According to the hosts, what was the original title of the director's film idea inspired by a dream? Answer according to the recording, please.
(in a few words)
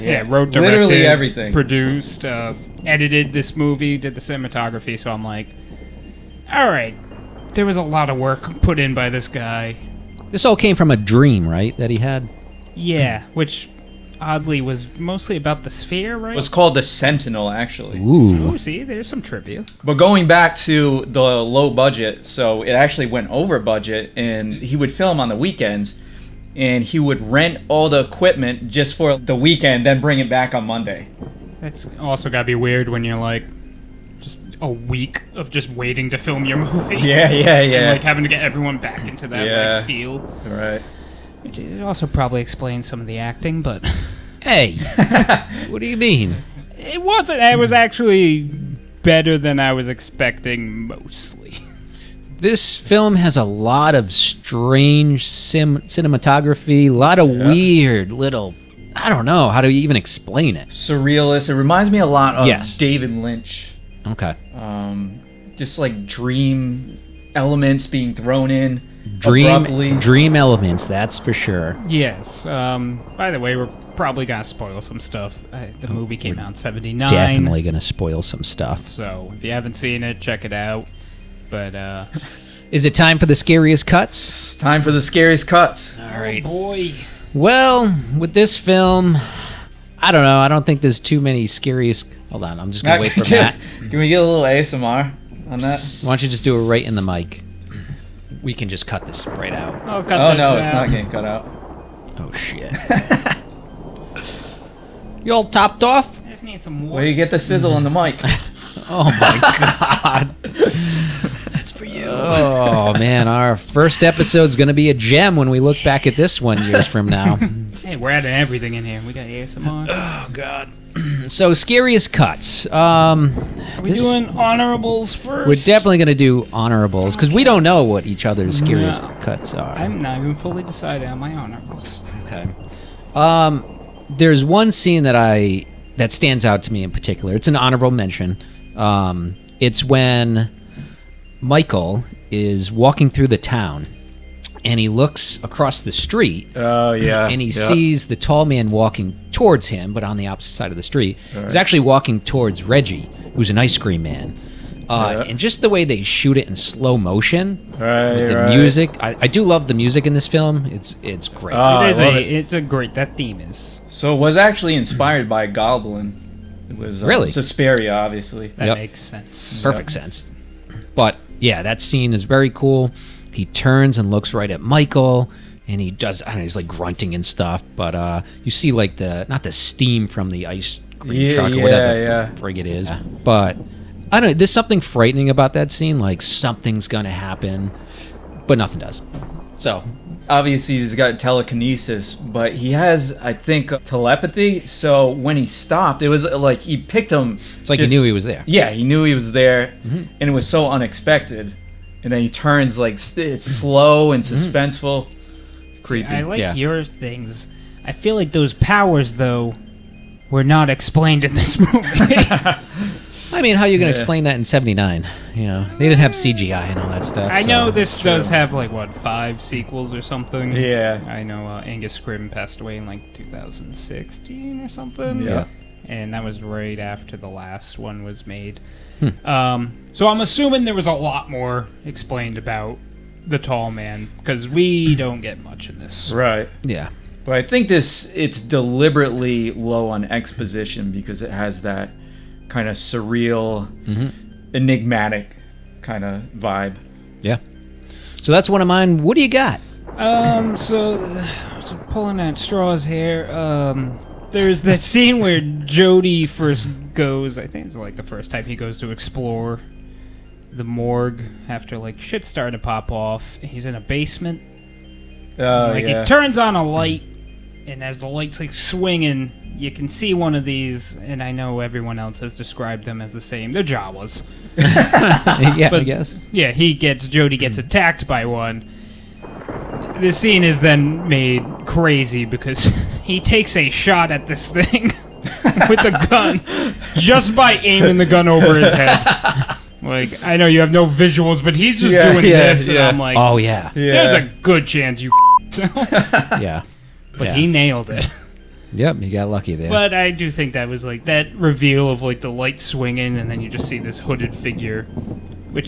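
The Sentinel.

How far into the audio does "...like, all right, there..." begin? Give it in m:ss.
0:05.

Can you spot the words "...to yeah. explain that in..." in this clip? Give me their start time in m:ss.
3:33.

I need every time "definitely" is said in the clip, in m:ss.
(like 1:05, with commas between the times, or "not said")
1:17, 2:05.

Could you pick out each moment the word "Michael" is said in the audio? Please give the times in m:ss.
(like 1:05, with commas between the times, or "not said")
2:21, 2:54.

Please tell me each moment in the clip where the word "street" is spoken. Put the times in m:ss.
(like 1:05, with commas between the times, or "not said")
2:25, 2:30.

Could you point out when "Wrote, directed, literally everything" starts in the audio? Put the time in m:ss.
0:00.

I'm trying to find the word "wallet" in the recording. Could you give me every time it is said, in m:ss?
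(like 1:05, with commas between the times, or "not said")
not said.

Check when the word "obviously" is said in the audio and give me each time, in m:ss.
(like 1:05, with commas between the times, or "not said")
2:47, 3:10.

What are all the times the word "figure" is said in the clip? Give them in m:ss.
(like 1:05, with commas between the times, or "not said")
5:04.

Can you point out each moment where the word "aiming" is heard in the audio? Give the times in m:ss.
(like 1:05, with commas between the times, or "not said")
4:47.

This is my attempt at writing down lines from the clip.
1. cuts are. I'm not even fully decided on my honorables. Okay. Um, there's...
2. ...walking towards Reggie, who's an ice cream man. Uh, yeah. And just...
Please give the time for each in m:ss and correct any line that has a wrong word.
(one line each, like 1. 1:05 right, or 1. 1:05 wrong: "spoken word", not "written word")
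1. 2:09 right
2. 2:31 right.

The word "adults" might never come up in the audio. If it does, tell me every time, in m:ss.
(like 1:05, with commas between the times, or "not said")
not said.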